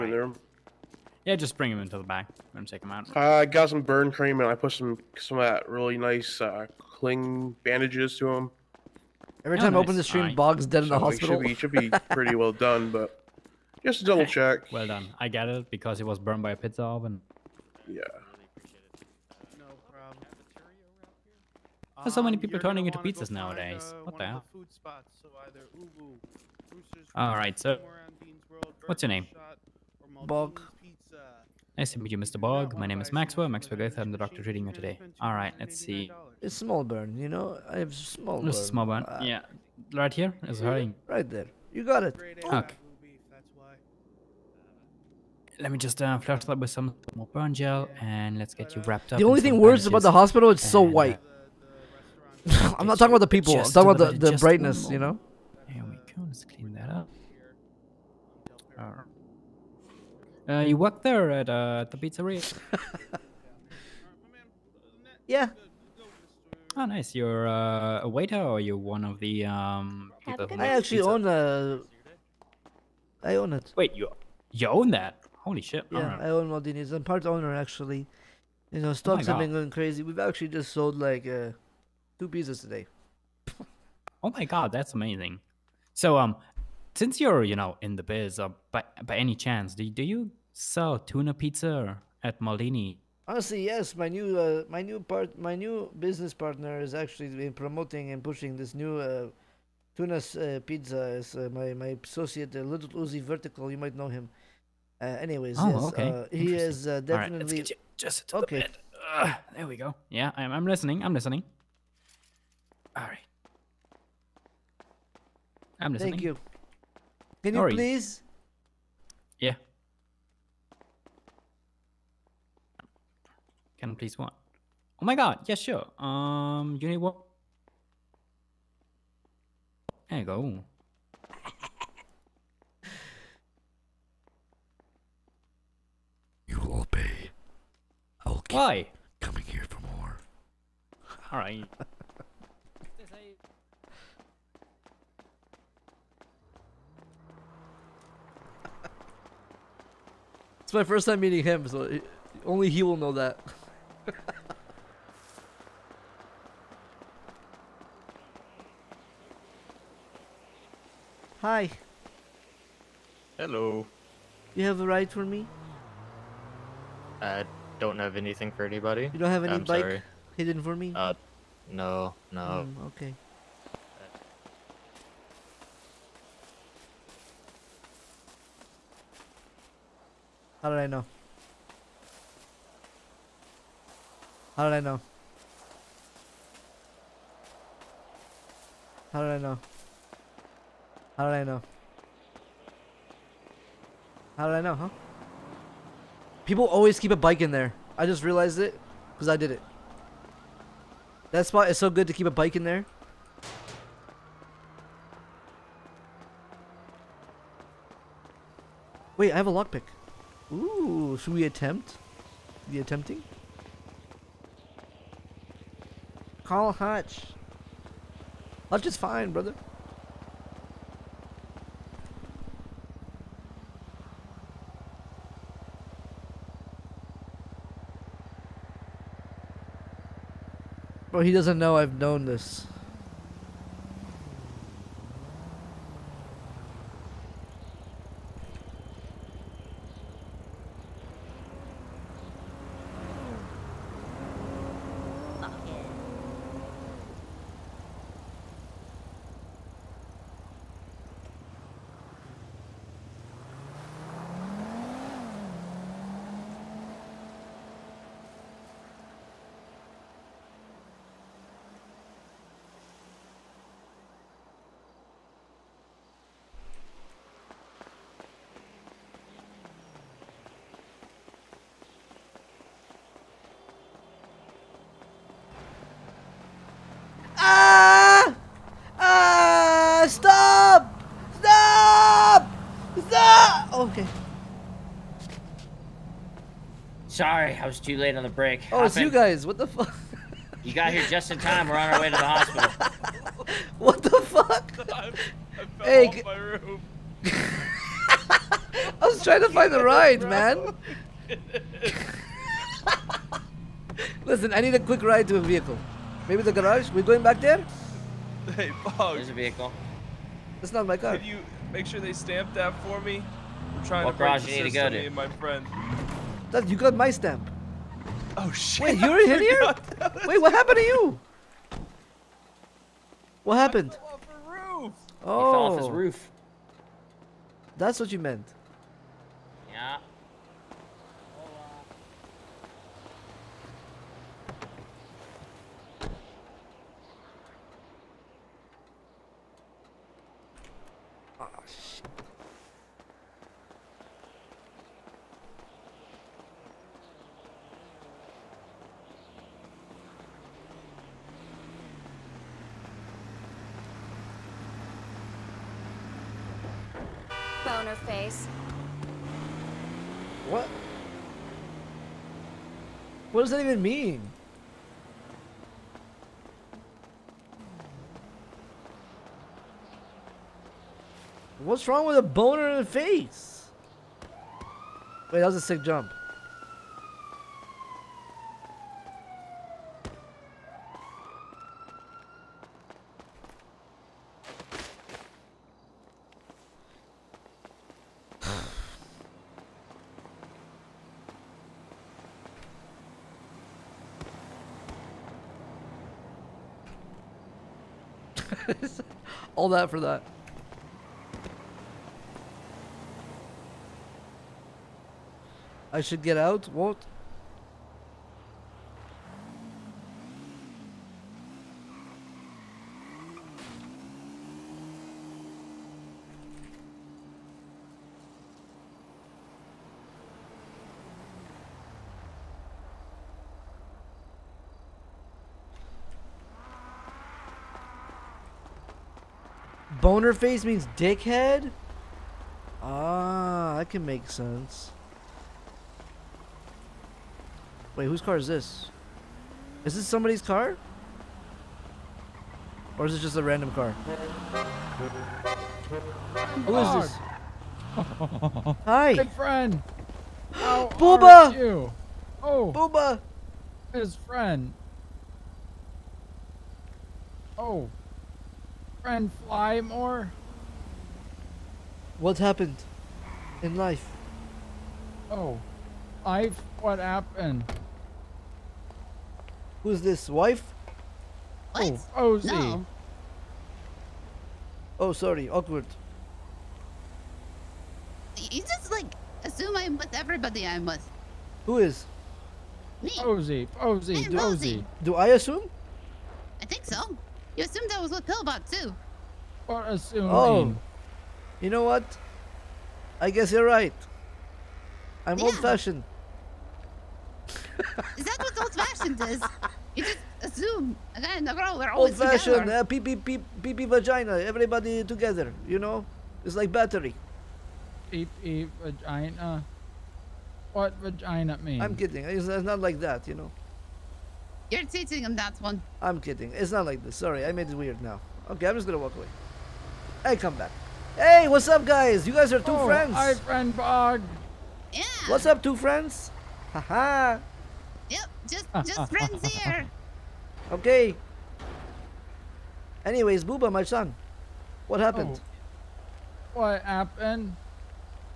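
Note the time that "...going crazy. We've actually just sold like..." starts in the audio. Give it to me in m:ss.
1:19.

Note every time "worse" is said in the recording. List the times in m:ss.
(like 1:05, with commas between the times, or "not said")
0:49.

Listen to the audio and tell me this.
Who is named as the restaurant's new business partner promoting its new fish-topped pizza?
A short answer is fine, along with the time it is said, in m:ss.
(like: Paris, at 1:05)
Little Uzi Vertical, at 1:42.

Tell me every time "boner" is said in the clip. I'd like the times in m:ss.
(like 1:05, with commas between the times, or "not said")
6:12, 7:10.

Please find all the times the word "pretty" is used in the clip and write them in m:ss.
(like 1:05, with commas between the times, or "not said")
0:12.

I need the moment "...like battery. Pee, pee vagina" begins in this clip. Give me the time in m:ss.
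8:26.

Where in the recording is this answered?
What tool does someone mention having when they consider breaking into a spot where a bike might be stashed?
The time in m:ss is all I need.
3:29.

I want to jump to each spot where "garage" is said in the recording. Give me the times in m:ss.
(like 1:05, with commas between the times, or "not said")
5:06, 5:14.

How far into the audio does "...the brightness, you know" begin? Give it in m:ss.
0:54.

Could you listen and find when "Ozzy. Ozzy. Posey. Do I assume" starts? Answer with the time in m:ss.
8:03.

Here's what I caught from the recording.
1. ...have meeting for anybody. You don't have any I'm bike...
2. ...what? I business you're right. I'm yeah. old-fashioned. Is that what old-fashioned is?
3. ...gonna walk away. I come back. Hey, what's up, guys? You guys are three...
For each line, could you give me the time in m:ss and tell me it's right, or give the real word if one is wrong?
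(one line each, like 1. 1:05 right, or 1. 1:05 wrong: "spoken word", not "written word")
1. 2:47 wrong: "anything", not "meeting"
2. 8:11 wrong: "guess", not "business"
3. 8:38 wrong: "two", not "three".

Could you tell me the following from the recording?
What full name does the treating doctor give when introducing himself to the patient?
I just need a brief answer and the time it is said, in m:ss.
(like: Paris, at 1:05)
Maxwell Goethe, at 0:33.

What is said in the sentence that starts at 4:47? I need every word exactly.
Sorry, I was too late on the break.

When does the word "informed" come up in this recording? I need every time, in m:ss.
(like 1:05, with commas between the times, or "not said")
not said.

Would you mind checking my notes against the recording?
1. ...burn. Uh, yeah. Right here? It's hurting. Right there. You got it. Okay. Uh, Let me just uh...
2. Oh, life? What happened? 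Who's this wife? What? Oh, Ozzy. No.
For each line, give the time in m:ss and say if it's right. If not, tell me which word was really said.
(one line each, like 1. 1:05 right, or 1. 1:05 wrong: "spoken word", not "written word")
1. 0:38 right
2. 7:45 right.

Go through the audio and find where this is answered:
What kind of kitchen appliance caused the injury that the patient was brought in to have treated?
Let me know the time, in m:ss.
0:16.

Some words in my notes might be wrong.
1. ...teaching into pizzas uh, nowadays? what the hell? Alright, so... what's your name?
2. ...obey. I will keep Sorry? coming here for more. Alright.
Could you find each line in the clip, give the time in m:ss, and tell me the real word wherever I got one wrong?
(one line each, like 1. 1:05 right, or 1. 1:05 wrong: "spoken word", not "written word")
1. 0:22 wrong: "turning", not "teaching"
2. 2:16 wrong: "Why", not "Sorry".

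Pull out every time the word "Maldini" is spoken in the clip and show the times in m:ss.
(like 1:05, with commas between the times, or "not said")
1:16, 1:32.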